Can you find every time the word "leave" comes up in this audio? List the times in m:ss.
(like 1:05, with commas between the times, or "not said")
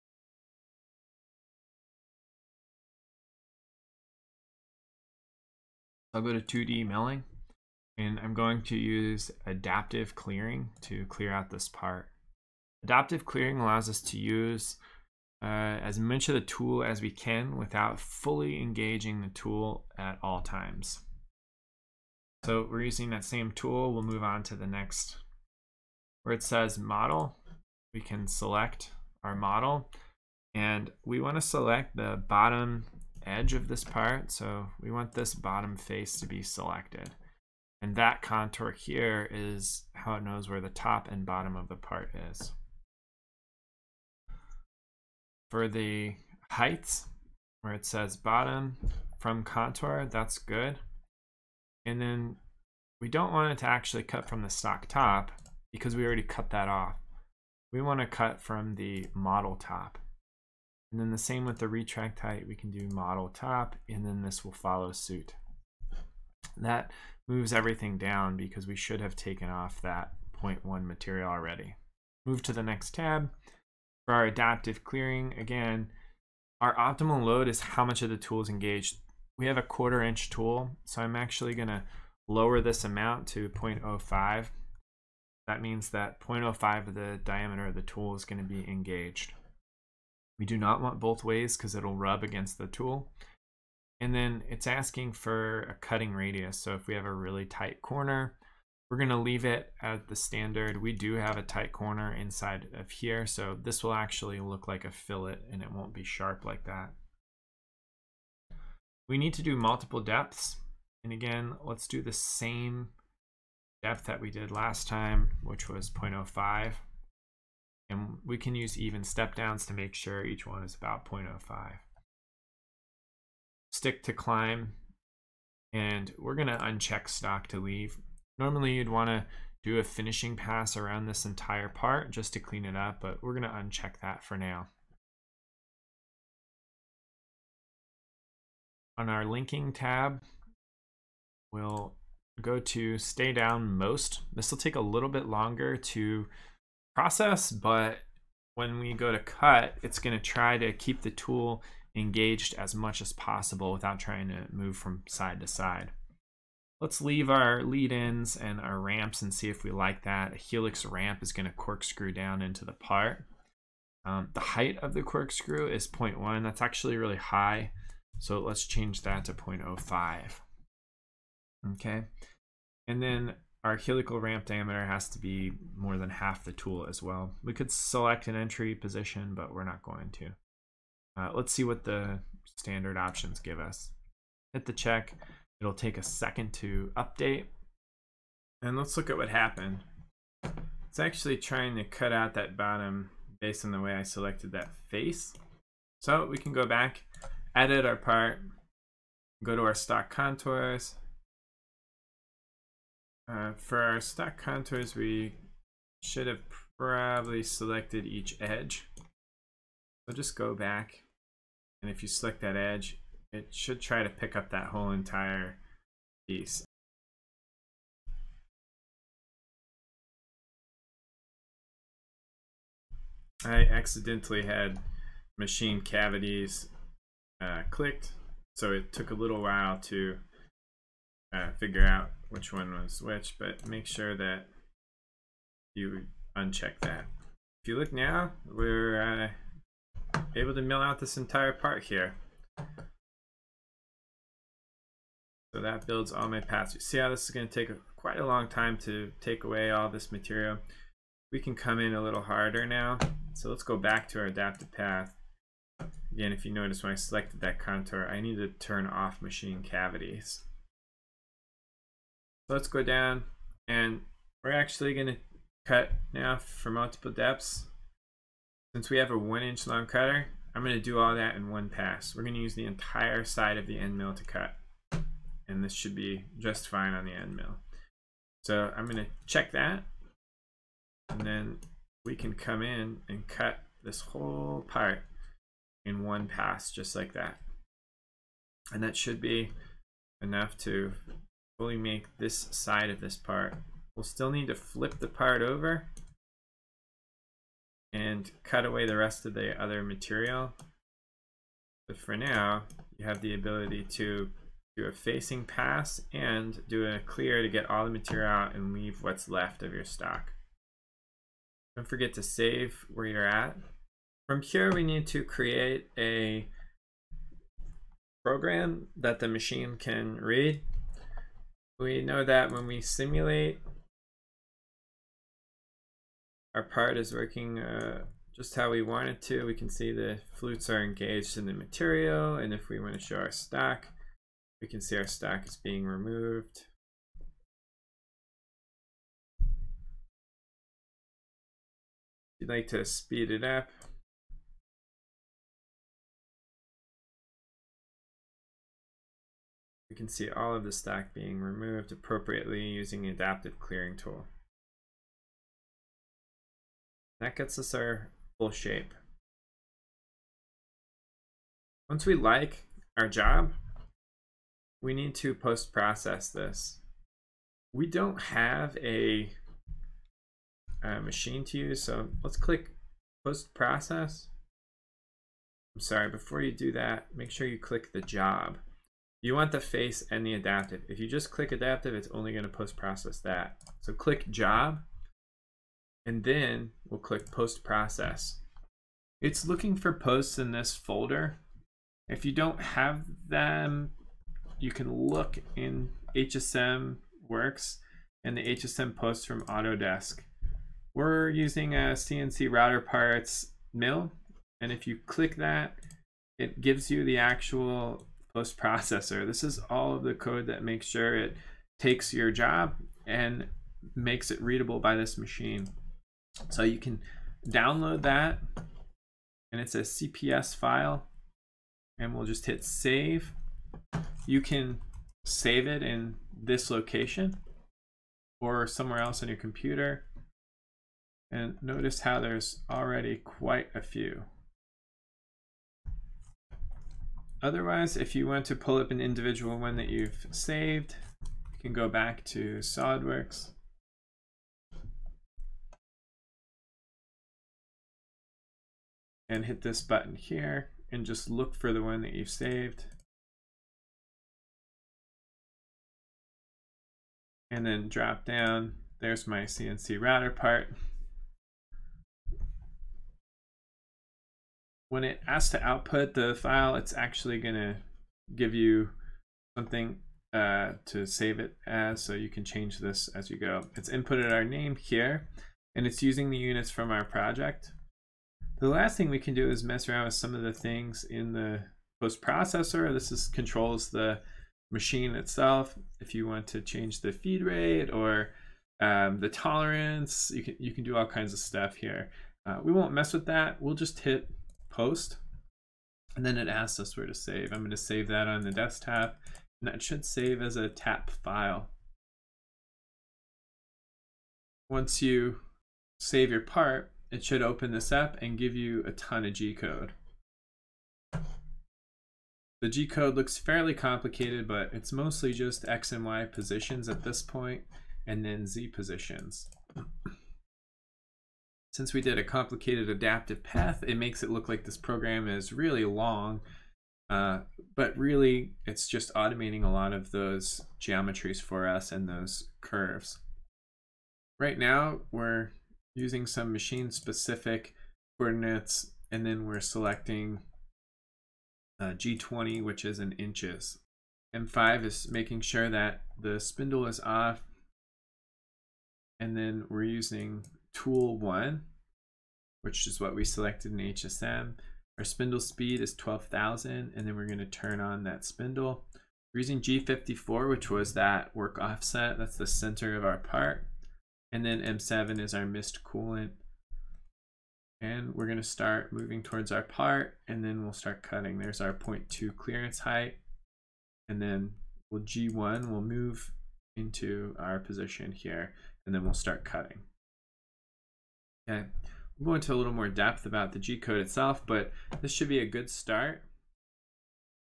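1:39, 2:07, 2:37, 5:08.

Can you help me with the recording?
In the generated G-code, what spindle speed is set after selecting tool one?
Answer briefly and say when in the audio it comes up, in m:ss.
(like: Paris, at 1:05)
12,000, at 9:15.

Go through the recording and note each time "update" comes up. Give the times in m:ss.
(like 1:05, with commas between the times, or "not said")
3:06.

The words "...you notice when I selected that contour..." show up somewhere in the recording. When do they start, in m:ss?
4:16.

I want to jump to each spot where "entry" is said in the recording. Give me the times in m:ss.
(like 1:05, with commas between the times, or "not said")
2:58.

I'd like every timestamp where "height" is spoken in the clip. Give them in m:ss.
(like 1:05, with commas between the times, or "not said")
0:46, 1:02, 2:44, 9:32.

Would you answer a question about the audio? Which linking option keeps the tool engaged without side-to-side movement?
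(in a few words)
stay down most.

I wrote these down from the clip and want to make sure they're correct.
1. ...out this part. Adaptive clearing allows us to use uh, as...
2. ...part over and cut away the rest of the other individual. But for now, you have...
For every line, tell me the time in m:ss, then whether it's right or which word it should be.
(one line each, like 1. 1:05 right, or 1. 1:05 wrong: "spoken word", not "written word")
1. 0:11 right
2. 4:55 wrong: "material", not "individual".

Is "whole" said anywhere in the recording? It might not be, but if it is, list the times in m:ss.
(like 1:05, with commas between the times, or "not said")
3:34, 4:44.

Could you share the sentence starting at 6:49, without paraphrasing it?
This is all of the code that makes sure it takes your job and makes it readable by this machine.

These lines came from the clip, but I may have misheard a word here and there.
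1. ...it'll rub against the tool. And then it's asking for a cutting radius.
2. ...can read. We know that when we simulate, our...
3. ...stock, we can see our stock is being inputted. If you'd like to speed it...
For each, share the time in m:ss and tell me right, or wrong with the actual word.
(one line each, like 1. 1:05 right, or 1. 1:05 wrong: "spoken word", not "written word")
1. 1:31 right
2. 5:19 right
3. 5:33 wrong: "removed", not "inputted".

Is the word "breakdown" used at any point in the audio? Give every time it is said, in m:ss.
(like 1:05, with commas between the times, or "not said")
not said.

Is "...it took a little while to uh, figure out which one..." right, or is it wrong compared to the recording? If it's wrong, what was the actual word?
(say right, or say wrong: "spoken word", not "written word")
right.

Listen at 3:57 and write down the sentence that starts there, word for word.
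If you look now, we're uh, able to mill out this entire part here.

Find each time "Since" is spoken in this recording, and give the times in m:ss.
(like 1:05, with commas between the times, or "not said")
4:28, 8:41.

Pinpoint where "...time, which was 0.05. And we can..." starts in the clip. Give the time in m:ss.
1:54.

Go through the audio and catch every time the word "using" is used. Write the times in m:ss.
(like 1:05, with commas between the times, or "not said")
0:22, 5:52, 6:41, 7:56, 8:55, 9:09, 9:19.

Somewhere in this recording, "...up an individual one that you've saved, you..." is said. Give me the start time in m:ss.
7:18.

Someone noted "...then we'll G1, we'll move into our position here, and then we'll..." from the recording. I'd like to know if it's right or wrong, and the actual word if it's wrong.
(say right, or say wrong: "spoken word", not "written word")
right.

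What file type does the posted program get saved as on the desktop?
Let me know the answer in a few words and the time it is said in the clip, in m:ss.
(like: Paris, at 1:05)
tap file, at 8:20.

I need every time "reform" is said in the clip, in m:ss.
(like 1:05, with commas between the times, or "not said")
not said.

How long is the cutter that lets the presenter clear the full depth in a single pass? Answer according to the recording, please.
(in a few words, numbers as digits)
1 inch.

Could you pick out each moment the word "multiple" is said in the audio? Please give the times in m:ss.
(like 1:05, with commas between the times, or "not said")
1:49, 4:26.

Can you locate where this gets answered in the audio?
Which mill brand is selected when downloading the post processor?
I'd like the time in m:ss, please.
6:41.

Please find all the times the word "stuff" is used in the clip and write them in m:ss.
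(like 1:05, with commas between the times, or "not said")
8:11.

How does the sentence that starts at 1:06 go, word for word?
that moves everything down because we should have taken off that 0.1 material already.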